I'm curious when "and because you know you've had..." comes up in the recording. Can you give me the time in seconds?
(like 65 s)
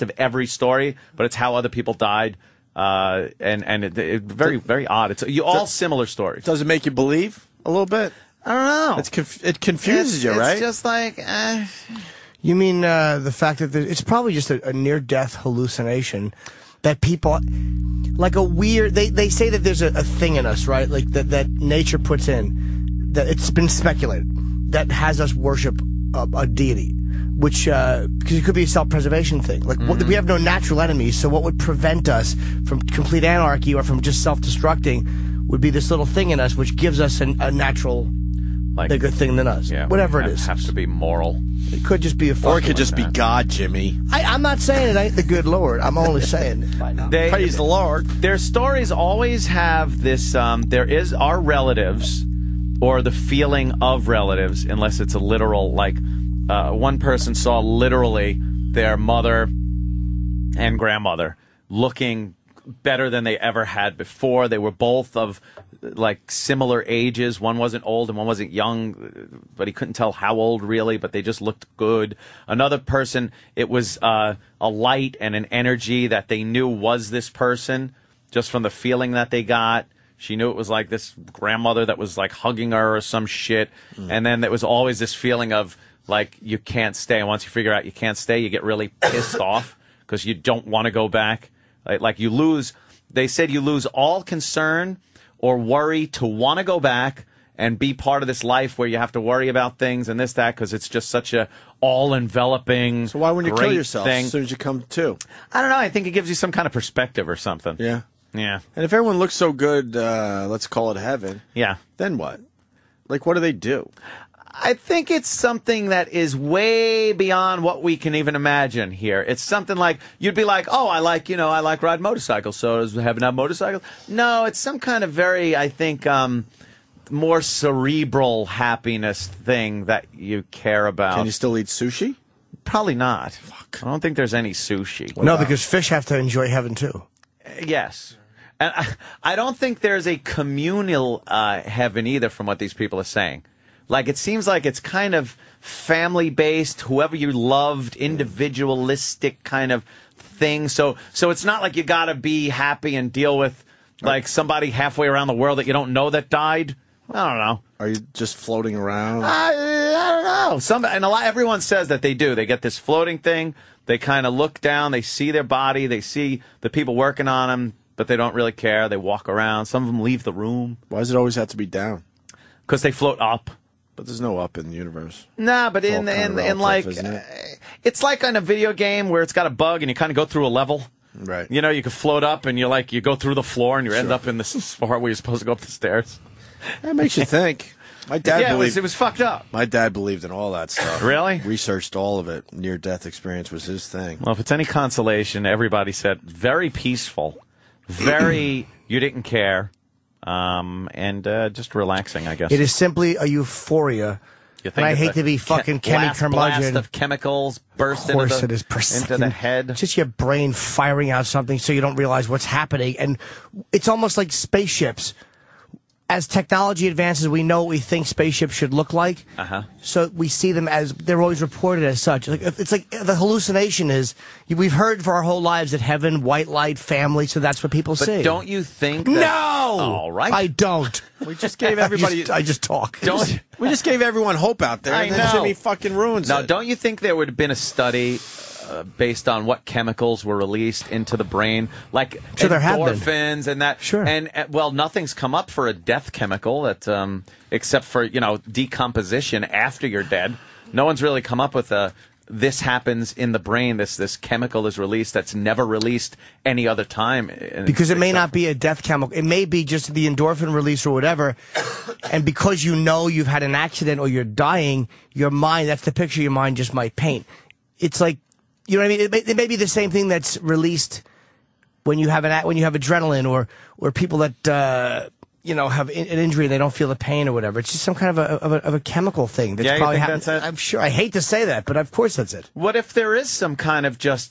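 262 s.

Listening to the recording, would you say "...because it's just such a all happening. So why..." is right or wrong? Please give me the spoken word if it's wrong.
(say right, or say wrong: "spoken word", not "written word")
wrong: "enveloping", not "happening".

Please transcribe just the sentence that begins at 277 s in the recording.
It's just some kind of a of a, of a chemical thing that's yeah, probably happening.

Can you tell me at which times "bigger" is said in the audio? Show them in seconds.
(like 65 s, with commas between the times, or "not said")
38 s.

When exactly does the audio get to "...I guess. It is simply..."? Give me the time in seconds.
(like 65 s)
202 s.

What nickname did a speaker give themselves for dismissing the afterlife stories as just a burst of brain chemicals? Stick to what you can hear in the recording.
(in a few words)
Kenny Curmudgeon.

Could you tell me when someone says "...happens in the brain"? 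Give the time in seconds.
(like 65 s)
252 s.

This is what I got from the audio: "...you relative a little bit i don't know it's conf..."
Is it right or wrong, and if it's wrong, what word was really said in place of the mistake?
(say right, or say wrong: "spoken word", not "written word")
wrong: "believe", not "relative".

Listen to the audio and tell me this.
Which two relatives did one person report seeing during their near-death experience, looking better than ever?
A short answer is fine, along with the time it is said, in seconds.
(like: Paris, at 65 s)
Mother and grandmother, at 58 s.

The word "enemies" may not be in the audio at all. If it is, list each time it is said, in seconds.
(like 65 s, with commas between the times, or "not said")
30 s.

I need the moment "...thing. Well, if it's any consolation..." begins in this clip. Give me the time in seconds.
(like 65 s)
193 s.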